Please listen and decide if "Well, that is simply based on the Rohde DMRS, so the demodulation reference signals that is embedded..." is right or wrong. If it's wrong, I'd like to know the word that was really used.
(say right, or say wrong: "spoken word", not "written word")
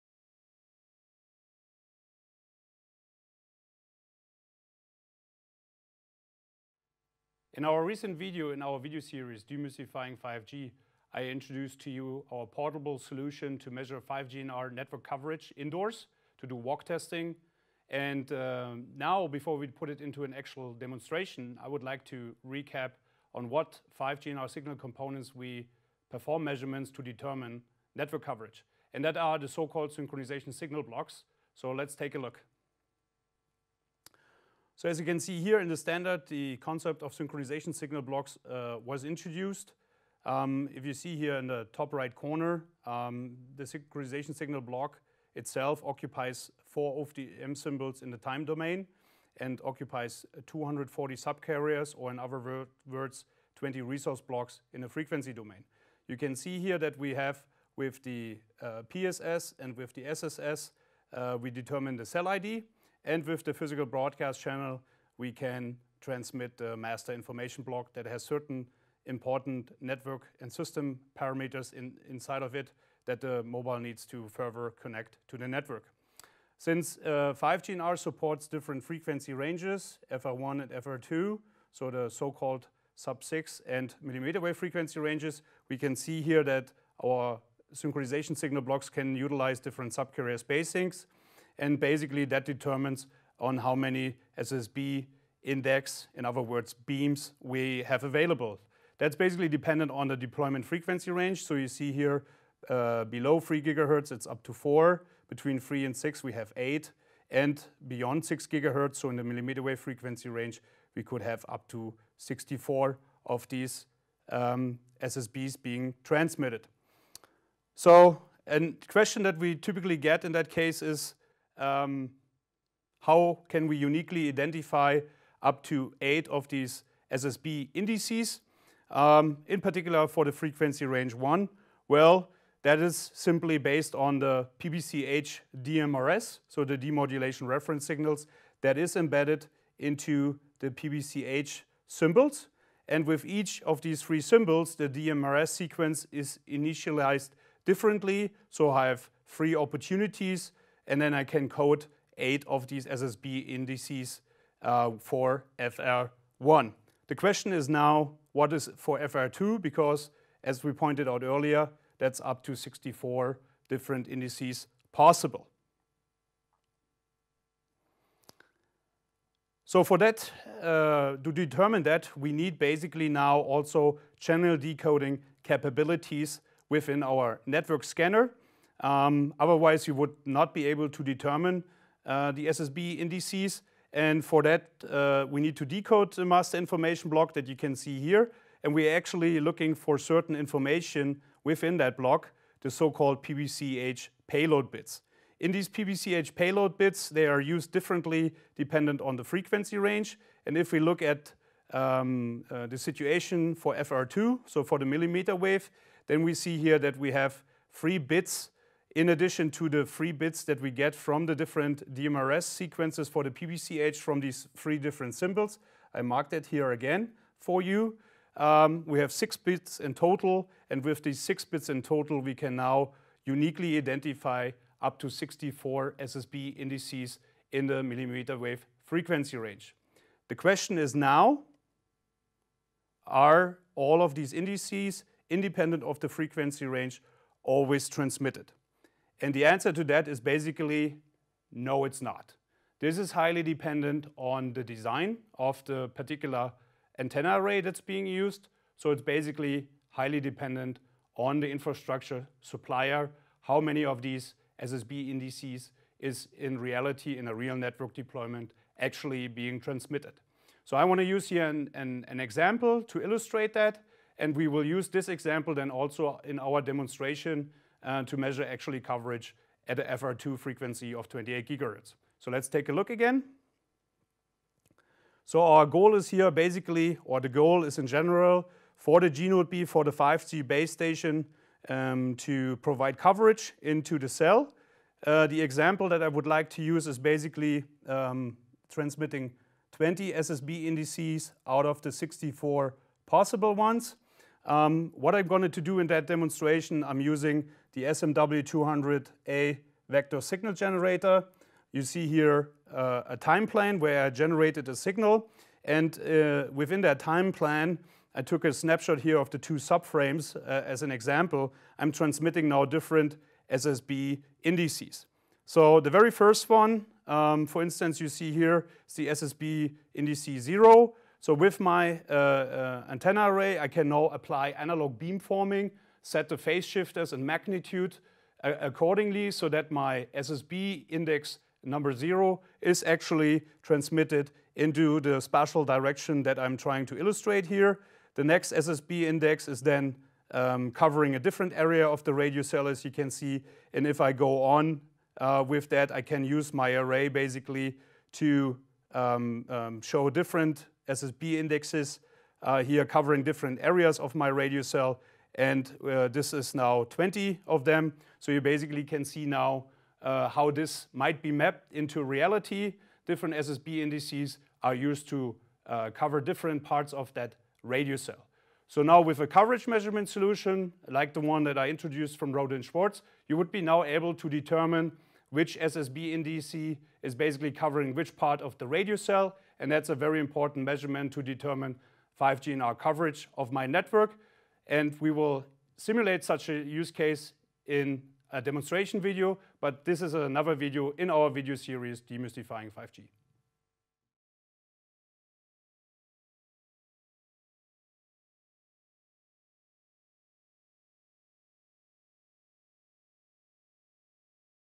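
wrong: "PBCH", not "Rohde".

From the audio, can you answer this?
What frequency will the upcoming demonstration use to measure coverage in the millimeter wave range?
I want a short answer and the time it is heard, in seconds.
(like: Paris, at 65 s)
28 gigahertz, at 271 s.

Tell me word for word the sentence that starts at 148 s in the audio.
So I have three opportunities and then I can code eight of these SSB indices uh, for FR1.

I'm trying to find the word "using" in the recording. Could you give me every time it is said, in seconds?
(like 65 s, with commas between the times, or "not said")
296 s.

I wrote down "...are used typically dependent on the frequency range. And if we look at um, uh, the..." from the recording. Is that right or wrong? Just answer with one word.
wrong.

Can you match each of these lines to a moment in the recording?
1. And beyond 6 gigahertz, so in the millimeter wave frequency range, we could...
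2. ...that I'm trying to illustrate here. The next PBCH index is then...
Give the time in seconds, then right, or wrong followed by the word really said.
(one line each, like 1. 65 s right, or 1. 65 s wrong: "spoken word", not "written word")
1. 107 s right
2. 336 s wrong: "SSB", not "PBCH".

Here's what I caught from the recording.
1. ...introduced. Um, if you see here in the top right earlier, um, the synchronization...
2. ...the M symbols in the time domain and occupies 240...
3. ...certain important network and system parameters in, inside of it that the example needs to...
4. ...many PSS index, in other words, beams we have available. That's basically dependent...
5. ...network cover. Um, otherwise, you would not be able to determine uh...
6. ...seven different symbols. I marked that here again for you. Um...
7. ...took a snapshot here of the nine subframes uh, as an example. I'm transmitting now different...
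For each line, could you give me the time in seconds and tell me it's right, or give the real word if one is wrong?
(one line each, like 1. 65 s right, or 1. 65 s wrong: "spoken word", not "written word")
1. 39 s wrong: "corner", not "earlier"
2. 47 s right
3. 68 s wrong: "mobile", not "example"
4. 93 s wrong: "SSB", not "PSS"
5. 177 s wrong: "scanner", not "cover"
6. 214 s wrong: "three", not "seven"
7. 308 s wrong: "two", not "nine".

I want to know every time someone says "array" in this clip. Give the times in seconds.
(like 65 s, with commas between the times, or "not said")
247 s, 323 s, 346 s.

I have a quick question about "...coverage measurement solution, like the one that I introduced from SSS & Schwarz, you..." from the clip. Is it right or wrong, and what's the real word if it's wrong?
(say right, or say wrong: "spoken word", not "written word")
wrong: "Rohde", not "SSS".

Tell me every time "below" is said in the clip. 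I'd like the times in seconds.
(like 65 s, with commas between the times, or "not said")
103 s.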